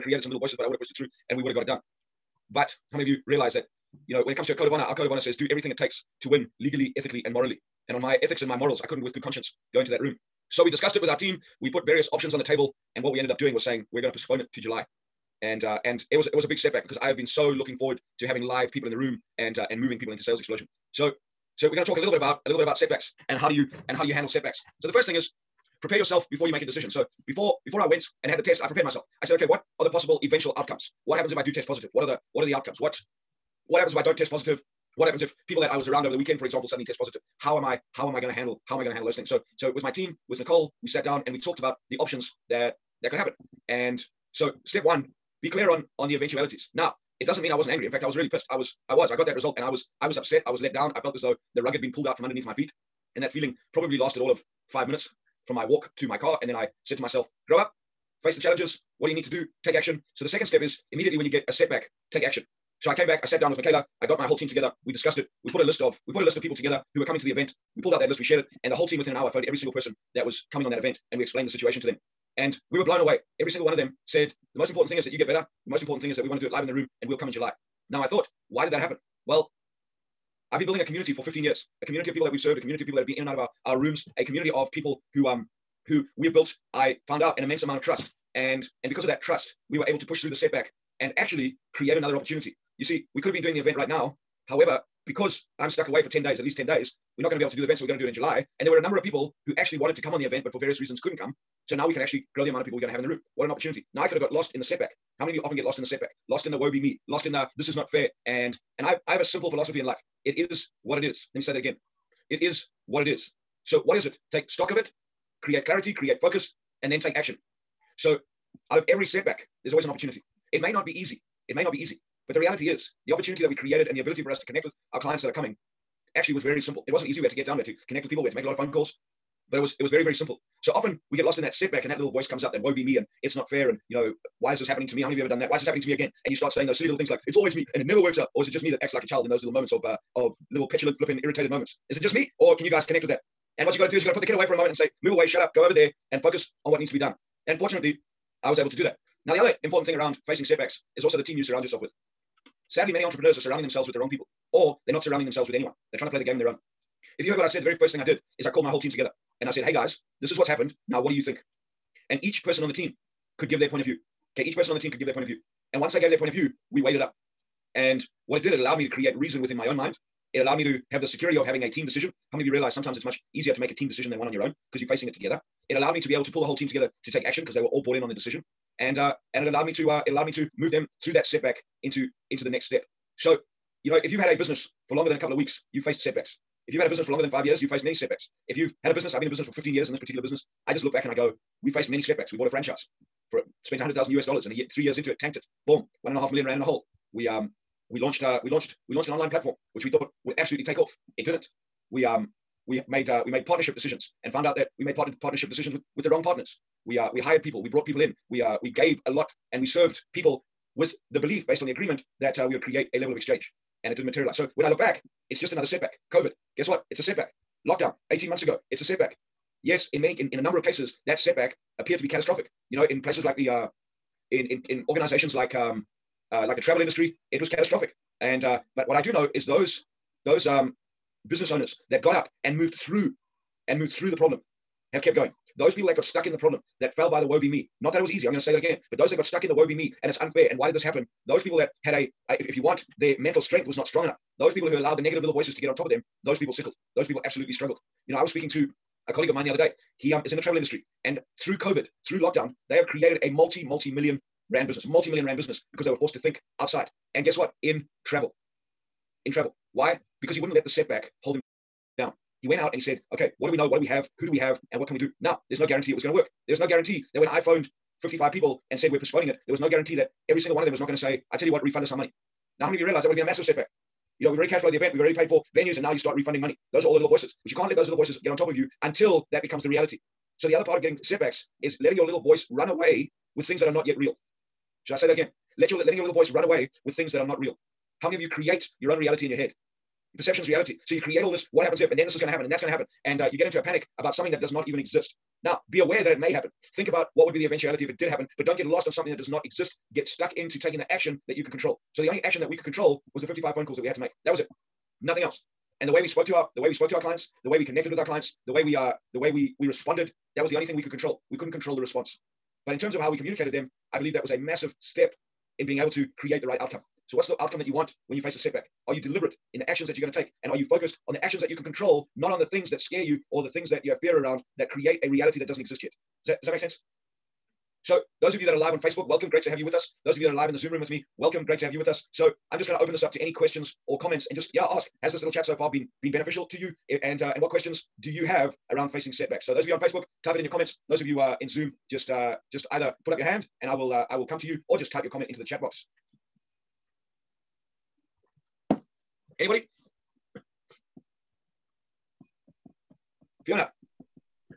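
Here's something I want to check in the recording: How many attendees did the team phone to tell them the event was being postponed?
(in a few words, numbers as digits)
55.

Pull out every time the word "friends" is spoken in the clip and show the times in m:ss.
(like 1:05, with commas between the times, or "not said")
not said.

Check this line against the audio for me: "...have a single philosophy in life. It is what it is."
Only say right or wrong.
wrong.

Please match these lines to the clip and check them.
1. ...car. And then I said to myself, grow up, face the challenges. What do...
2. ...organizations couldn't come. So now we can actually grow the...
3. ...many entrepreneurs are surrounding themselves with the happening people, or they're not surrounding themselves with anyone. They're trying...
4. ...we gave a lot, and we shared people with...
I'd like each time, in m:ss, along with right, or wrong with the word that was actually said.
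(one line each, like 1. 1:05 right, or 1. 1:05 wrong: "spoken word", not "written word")
1. 0:56 right
2. 1:40 wrong: "reasons", not "organizations"
3. 2:32 wrong: "wrong", not "happening"
4. 3:28 wrong: "served", not "shared".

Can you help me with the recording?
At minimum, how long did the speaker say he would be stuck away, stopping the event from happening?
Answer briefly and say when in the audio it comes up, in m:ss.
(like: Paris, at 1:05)
10 days, at 1:36.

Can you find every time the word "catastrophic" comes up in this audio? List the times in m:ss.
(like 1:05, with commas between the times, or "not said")
3:42, 3:47.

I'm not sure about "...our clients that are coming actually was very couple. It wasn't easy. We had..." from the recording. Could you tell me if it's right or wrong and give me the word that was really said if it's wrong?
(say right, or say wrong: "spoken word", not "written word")
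wrong: "simple", not "couple".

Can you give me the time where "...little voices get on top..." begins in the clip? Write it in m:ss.
4:37.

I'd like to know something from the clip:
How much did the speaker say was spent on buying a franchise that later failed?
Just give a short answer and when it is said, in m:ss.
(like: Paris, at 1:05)
100,000 US dollars, at 3:13.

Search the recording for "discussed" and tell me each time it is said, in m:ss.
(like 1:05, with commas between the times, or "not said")
0:10, 1:04.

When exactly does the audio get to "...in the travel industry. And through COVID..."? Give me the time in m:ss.
4:10.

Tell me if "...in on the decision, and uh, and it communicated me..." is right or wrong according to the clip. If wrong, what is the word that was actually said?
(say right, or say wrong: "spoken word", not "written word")
wrong: "allowed", not "communicated".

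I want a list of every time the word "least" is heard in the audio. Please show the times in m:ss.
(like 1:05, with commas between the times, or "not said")
1:36.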